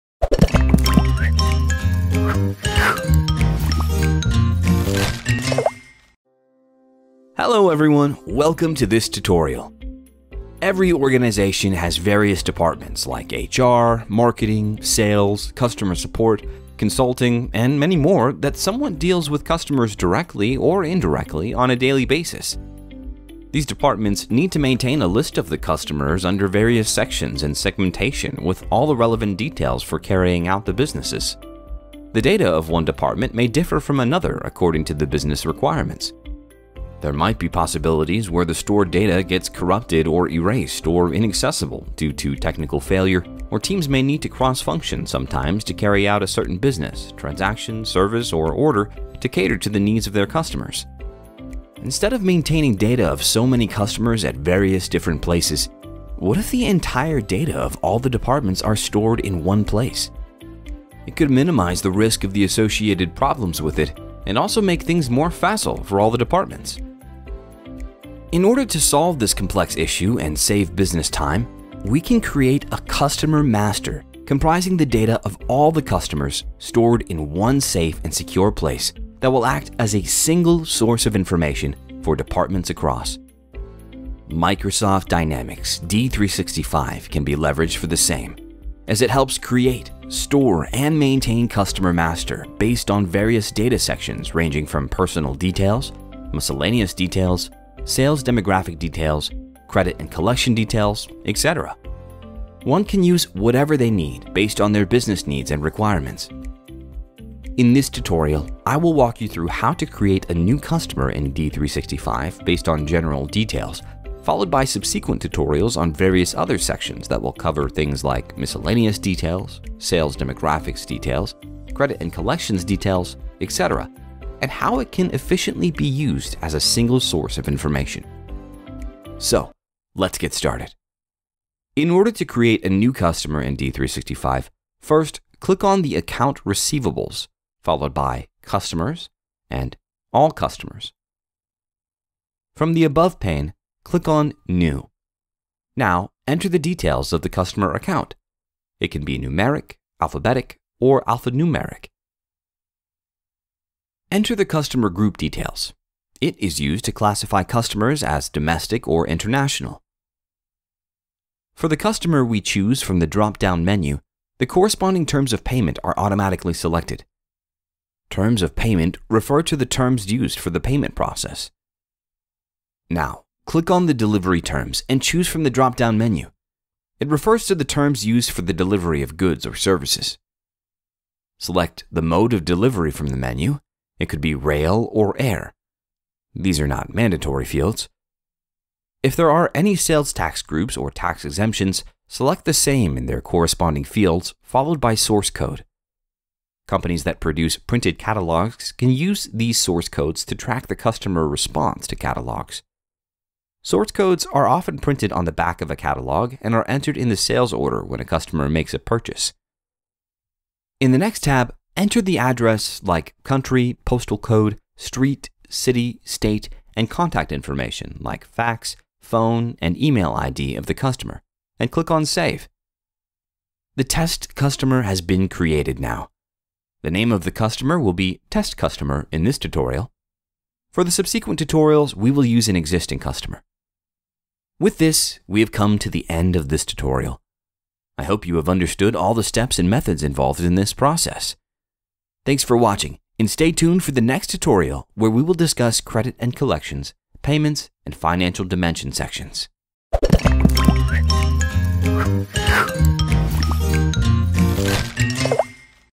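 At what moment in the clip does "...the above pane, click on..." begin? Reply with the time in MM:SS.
02:22.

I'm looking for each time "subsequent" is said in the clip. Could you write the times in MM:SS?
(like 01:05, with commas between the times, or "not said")
01:54, 03:50.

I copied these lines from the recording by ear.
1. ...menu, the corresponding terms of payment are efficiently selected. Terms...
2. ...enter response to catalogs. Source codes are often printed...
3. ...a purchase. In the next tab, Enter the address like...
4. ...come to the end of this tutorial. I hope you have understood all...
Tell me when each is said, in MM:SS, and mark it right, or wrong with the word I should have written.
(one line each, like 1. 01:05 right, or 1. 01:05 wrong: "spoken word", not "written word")
1. 02:43 wrong: "automatically", not "efficiently"
2. 03:20 wrong: "customer", not "enter"
3. 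03:28 right
4. 03:55 right.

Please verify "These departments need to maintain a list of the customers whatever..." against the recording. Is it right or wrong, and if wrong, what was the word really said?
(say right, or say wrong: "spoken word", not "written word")
wrong: "under", not "whatever".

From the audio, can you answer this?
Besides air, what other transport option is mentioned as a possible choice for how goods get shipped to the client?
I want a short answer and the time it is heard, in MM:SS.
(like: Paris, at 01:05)
rail, at 03:04.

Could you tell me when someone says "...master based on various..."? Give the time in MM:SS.
01:31.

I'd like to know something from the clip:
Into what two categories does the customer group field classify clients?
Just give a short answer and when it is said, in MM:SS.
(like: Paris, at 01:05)
domestic or international, at 02:38.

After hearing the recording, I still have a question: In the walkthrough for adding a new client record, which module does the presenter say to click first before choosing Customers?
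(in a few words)
Account Receivables.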